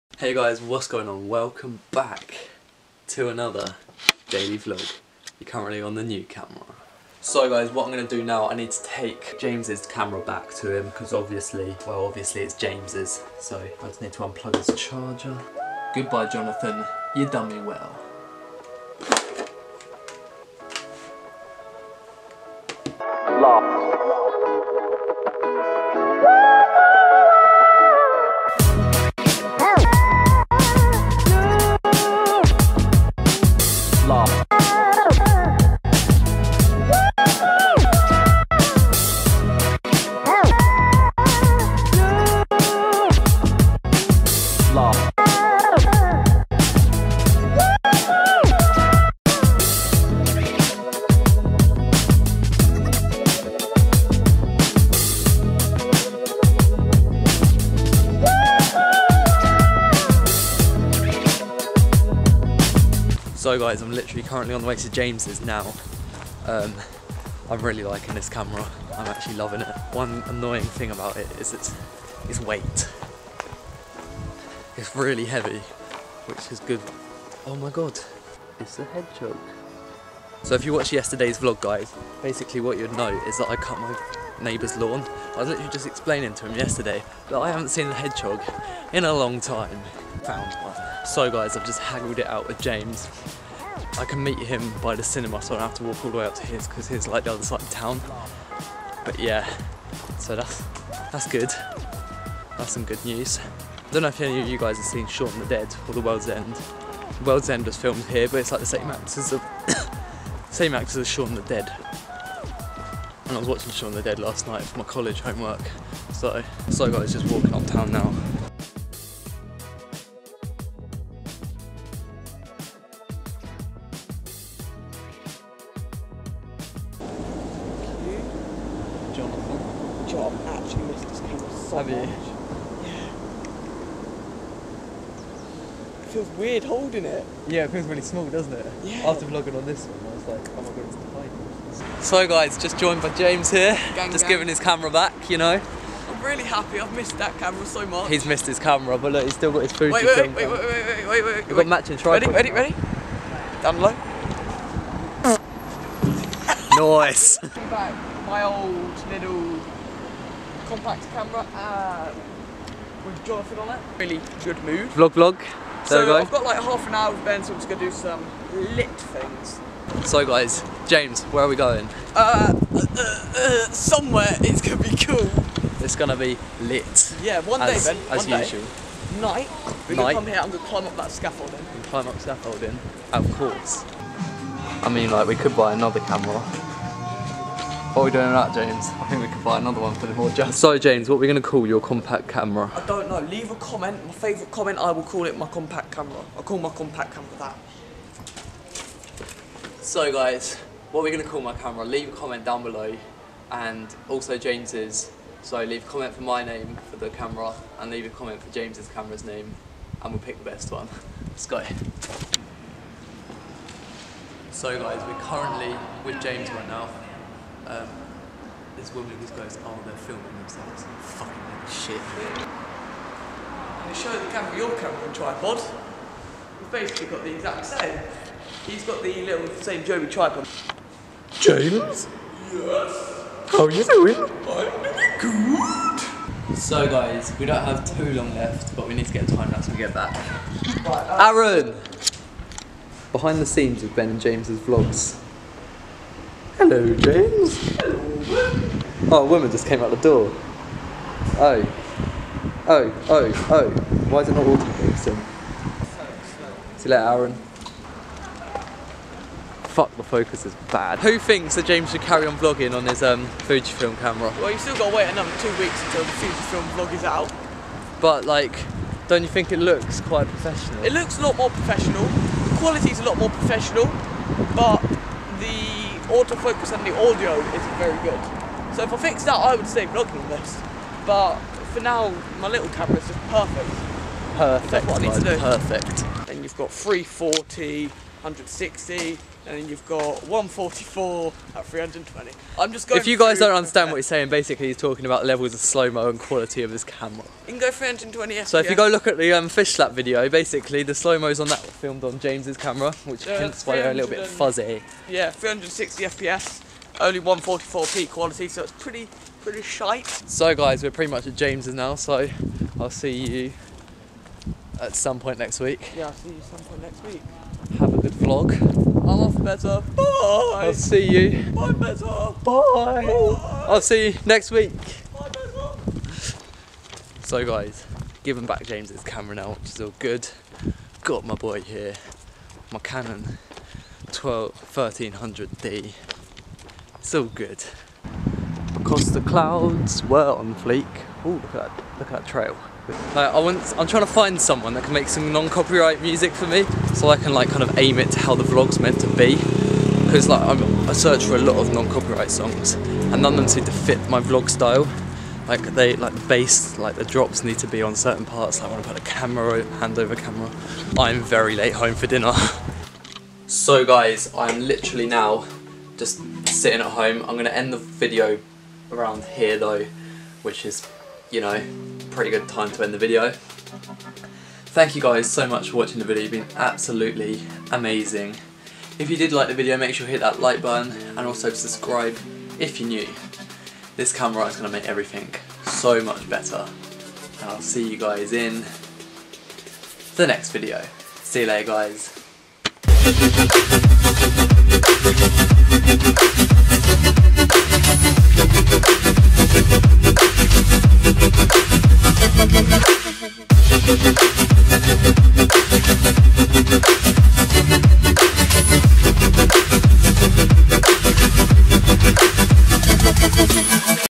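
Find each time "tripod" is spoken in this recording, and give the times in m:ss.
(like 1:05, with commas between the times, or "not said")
2:31, 3:45, 3:50.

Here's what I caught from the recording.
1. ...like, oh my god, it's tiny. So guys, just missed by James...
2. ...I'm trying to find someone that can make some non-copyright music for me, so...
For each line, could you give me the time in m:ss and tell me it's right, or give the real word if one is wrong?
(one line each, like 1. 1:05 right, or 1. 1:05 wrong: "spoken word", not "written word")
1. 2:20 wrong: "joined", not "missed"
2. 5:43 right.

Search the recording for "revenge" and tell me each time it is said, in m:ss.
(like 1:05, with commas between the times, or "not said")
not said.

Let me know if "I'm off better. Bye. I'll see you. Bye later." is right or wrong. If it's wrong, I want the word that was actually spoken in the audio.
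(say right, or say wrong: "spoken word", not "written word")
wrong: "better", not "later".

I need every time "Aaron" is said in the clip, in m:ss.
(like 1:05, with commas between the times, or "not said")
4:01, 4:17.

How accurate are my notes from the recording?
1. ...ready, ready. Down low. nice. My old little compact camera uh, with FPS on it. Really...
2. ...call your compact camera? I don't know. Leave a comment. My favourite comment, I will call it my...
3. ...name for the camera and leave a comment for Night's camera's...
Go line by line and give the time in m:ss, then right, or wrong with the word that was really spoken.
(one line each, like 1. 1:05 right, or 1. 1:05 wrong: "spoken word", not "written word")
1. 2:32 wrong: "Jonathan", not "FPS"
2. 3:11 right
3. 3:26 wrong: "James", not "Night".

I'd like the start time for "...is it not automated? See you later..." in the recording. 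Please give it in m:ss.
4:14.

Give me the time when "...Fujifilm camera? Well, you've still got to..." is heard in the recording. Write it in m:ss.
4:23.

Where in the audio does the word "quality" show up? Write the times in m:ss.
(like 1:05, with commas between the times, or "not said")
4:32, 4:56, 5:08.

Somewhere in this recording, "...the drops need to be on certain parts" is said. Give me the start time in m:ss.
5:56.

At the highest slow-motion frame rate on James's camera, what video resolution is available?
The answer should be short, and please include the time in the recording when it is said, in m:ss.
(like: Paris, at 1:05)
144p, at 5:07.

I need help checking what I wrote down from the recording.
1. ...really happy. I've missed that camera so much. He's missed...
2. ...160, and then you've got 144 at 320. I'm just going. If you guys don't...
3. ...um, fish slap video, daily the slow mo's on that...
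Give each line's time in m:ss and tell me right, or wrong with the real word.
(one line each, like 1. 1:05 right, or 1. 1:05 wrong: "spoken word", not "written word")
1. 2:26 right
2. 4:48 right
3. 4:59 wrong: "basically", not "daily".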